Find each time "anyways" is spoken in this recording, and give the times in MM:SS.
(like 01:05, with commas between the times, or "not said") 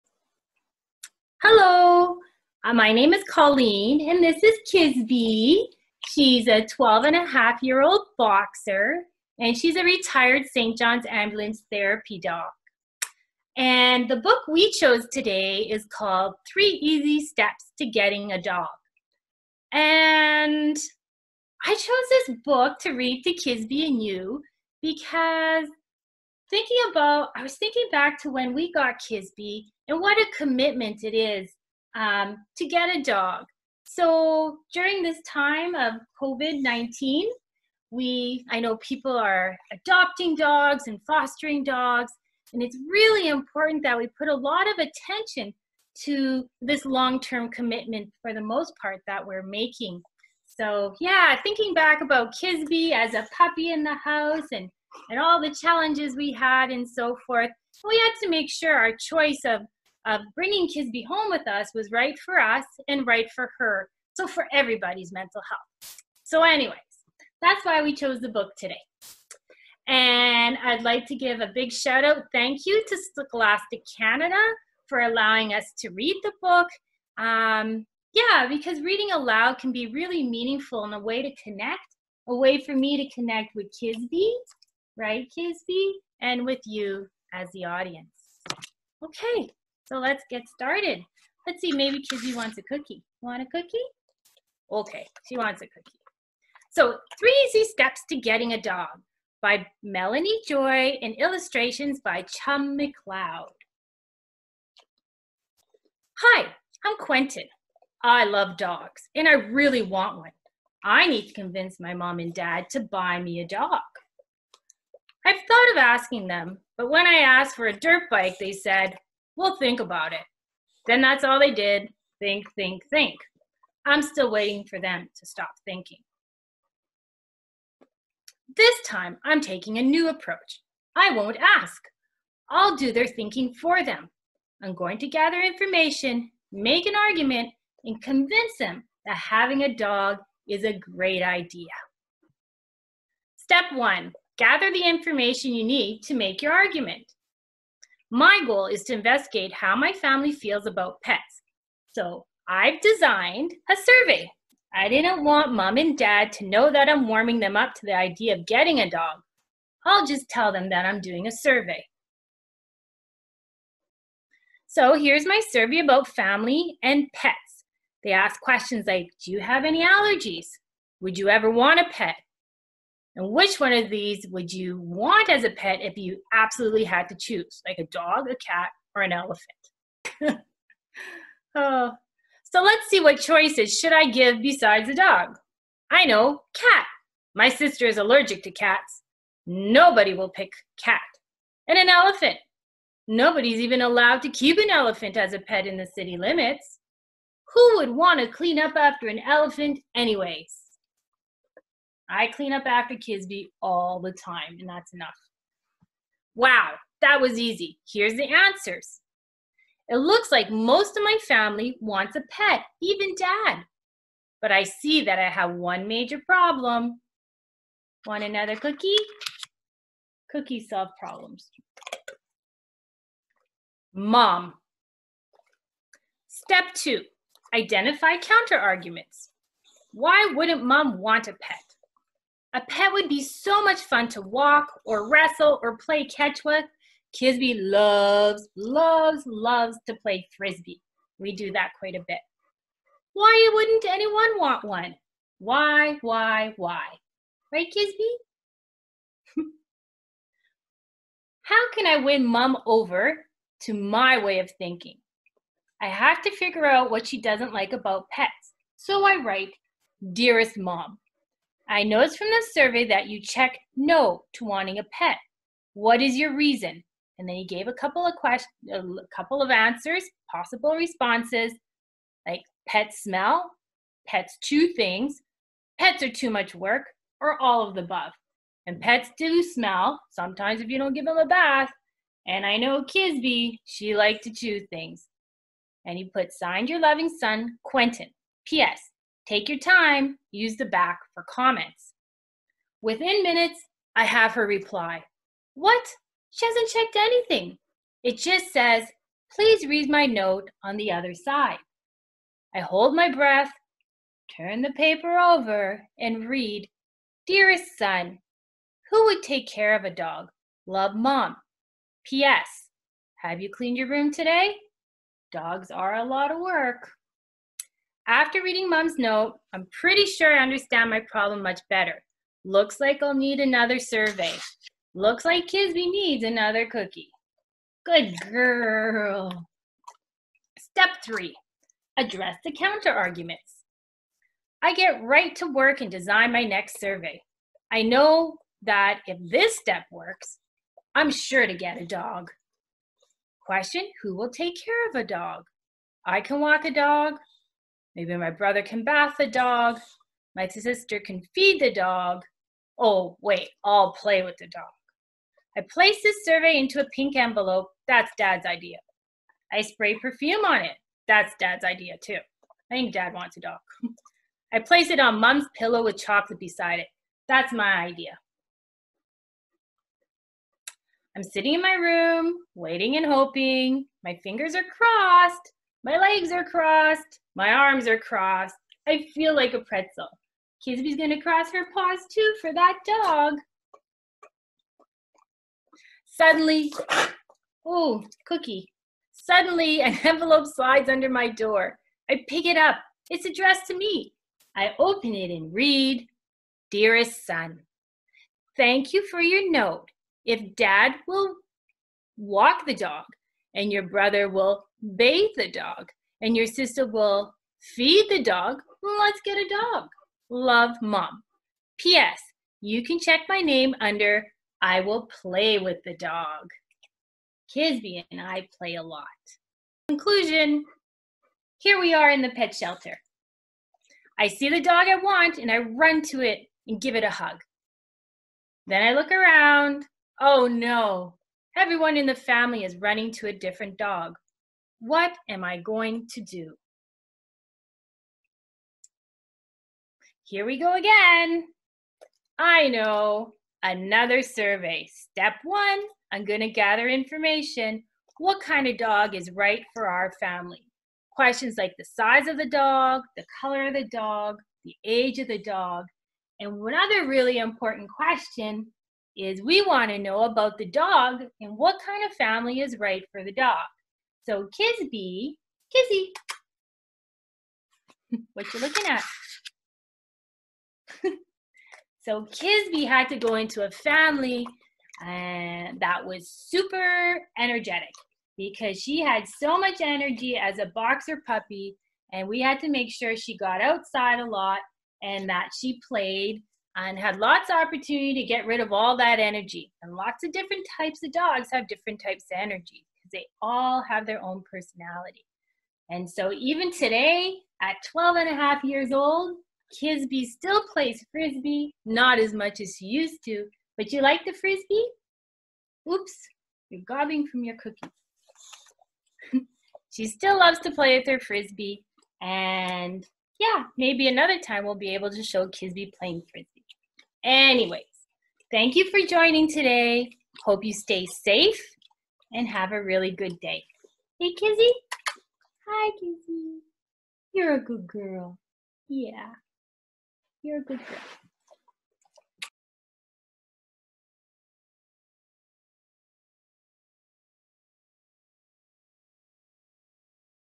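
01:06, 03:19, 08:37.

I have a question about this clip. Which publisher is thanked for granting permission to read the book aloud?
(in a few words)
Scholastic Canada.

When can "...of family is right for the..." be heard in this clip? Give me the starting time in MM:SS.
07:42.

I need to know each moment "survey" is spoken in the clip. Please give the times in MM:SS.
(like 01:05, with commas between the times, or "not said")
02:33, 02:41, 02:45, 04:22, 05:23, 05:36, 05:56, 07:24.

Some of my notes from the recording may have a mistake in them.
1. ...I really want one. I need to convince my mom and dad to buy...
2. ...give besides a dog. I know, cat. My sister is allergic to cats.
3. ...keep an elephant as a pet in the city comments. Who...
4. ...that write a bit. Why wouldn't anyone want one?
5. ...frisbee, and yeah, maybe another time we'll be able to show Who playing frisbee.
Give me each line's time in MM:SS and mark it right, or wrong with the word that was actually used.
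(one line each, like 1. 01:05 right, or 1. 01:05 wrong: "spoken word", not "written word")
1. 01:49 right
2. 03:04 right
3. 03:14 wrong: "limits", not "comments"
4. 04:01 wrong: "quite", not "write"
5. 08:31 wrong: "Kisbey", not "Who".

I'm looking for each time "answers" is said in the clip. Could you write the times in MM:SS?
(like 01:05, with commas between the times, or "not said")
03:28, 04:29.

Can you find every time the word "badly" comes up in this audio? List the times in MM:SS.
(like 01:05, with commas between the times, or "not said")
not said.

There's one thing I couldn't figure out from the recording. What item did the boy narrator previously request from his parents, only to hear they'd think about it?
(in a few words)
A dirt bike.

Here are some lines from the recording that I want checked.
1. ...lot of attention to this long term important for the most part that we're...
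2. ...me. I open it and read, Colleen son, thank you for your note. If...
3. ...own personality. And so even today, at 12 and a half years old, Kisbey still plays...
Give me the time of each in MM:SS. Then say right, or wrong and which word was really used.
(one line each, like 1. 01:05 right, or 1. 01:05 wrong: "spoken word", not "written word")
1. 00:44 wrong: "commitment", not "important"
2. 06:33 wrong: "Dearest", not "Colleen"
3. 08:14 right.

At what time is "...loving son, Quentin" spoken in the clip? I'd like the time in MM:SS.
04:46.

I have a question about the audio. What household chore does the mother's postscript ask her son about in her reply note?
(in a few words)
Cleaned your room.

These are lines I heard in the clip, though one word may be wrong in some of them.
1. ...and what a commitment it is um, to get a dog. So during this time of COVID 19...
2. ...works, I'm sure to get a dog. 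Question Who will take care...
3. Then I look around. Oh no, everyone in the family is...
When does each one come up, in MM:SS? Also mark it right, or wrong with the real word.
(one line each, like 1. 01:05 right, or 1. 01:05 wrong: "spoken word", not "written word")
1. 00:29 right
2. 05:39 right
3. 07:08 right.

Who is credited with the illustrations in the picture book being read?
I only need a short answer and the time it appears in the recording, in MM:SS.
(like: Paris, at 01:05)
Chum McLeod, at 01:42.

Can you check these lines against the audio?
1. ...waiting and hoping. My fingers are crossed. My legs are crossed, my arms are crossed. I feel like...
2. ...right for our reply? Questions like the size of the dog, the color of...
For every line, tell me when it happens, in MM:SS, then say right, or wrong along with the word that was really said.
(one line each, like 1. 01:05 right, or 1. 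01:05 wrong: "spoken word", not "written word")
1. 06:12 right
2. 07:29 wrong: "family", not "reply".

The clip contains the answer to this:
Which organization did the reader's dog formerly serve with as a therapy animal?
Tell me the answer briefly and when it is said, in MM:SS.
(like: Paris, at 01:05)
St. John's Ambulance, at 00:10.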